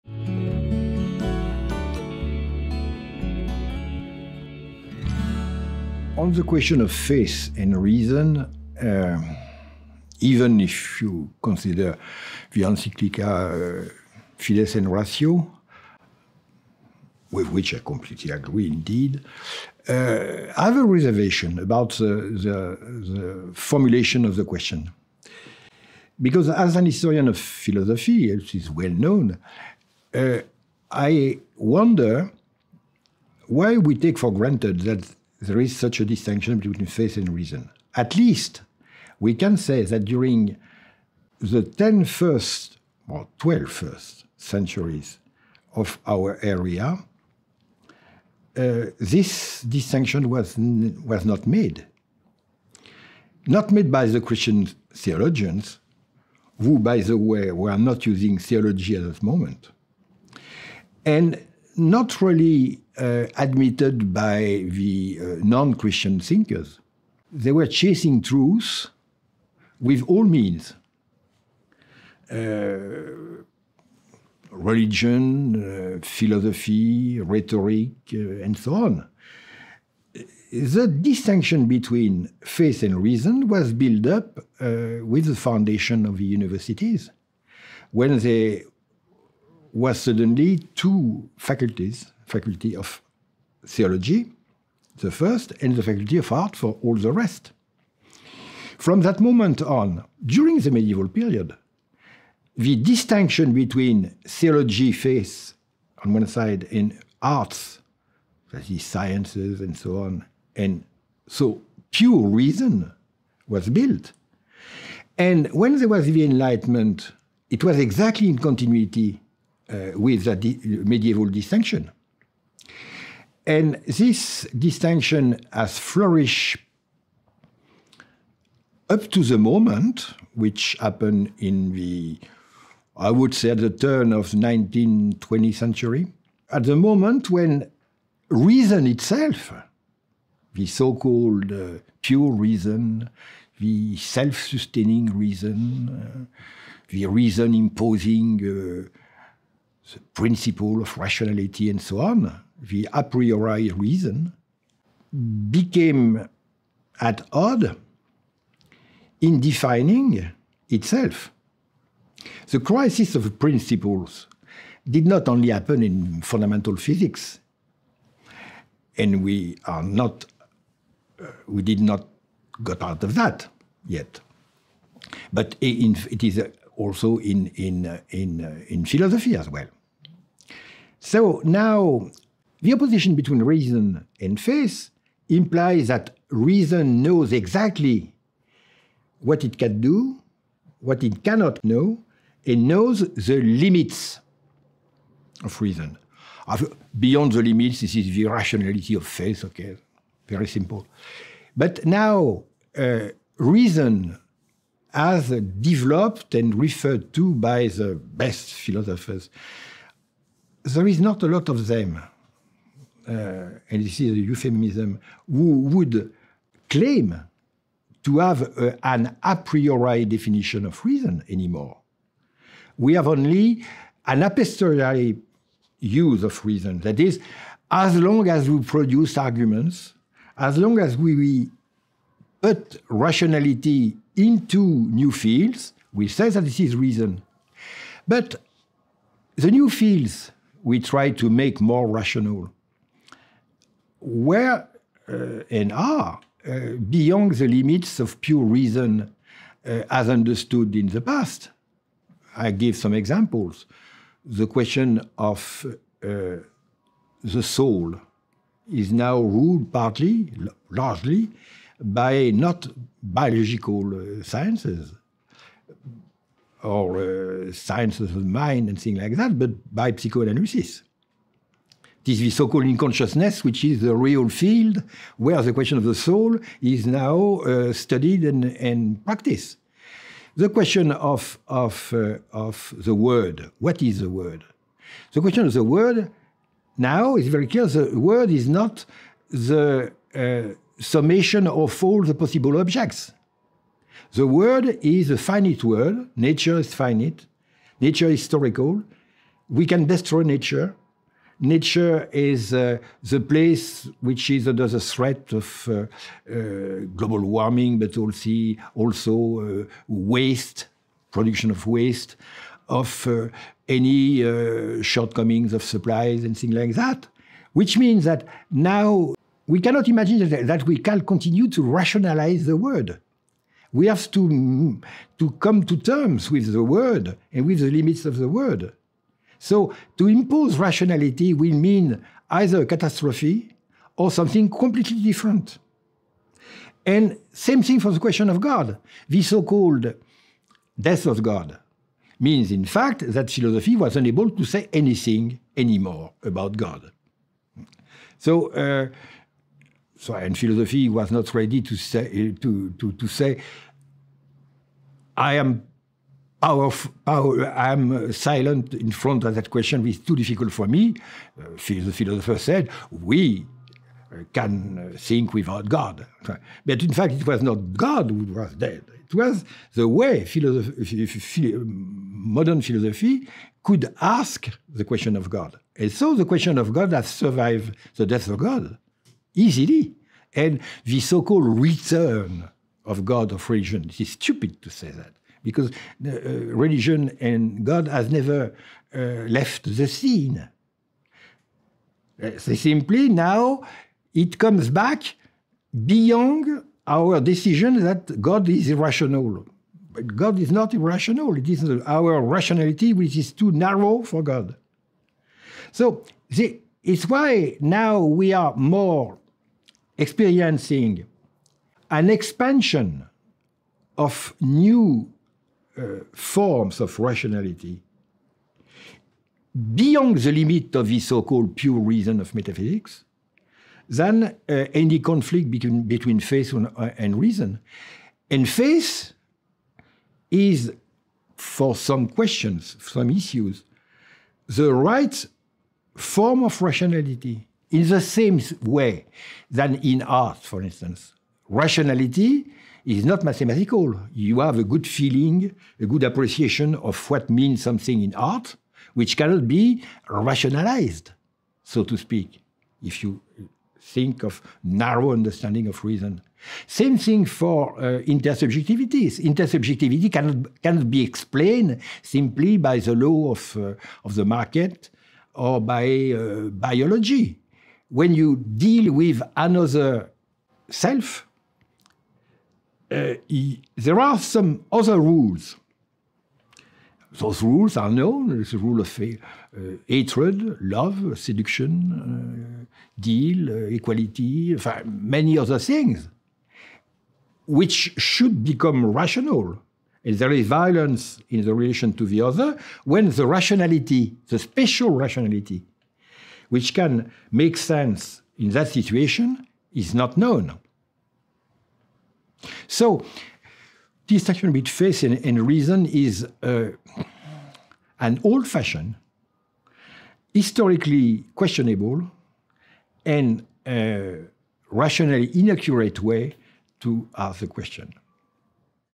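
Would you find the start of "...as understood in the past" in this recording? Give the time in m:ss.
4:09.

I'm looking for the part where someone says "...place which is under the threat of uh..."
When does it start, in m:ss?
5:03.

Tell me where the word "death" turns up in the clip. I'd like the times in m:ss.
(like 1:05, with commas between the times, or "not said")
5:40, 6:18.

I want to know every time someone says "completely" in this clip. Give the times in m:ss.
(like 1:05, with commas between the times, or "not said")
0:17, 5:34.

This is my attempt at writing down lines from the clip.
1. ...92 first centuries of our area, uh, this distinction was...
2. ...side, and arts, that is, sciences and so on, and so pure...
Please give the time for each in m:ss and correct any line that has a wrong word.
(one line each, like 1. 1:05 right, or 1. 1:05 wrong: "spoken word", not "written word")
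1. 0:43 wrong: "12", not "92"
2. 1:46 right.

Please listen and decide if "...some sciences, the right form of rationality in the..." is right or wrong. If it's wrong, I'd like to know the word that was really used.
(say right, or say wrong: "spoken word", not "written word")
wrong: "issues", not "sciences".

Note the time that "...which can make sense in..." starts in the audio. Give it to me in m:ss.
8:16.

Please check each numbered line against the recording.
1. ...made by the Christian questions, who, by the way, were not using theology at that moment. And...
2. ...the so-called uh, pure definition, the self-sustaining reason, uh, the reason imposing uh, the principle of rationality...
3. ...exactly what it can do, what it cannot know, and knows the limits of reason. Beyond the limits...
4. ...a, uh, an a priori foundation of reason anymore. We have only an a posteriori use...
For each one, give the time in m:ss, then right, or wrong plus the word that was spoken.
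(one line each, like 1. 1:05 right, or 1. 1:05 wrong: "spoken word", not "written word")
1. 0:53 wrong: "theologians", not "questions"
2. 2:20 wrong: "reason", not "definition"
3. 3:07 right
4. 3:38 wrong: "definition", not "foundation".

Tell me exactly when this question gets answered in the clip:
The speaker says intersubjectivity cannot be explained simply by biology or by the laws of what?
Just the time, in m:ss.
7:44.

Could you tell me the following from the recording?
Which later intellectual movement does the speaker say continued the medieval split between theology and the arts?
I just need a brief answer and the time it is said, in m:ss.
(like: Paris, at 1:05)
the Enlightenment, at 1:56.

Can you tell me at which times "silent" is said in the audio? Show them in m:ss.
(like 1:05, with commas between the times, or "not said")
5:58.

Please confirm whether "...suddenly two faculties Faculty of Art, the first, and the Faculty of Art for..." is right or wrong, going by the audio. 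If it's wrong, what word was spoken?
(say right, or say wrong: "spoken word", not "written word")
wrong: "Theology", not "Art".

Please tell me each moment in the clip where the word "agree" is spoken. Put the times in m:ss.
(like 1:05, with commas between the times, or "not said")
0:18.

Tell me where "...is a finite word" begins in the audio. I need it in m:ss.
4:54.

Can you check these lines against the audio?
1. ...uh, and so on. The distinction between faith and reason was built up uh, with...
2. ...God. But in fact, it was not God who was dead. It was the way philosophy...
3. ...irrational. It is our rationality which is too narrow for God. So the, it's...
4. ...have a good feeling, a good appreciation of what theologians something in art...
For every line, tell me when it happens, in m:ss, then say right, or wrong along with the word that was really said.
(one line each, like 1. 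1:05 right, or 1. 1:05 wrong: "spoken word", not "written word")
1. 1:18 right
2. 6:05 right
3. 6:40 right
4. 7:24 wrong: "means", not "theologians".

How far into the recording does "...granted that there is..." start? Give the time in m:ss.
0:34.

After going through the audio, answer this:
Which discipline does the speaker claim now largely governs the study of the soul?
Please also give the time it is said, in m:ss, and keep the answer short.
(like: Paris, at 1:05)
psychoanalysis, at 4:29.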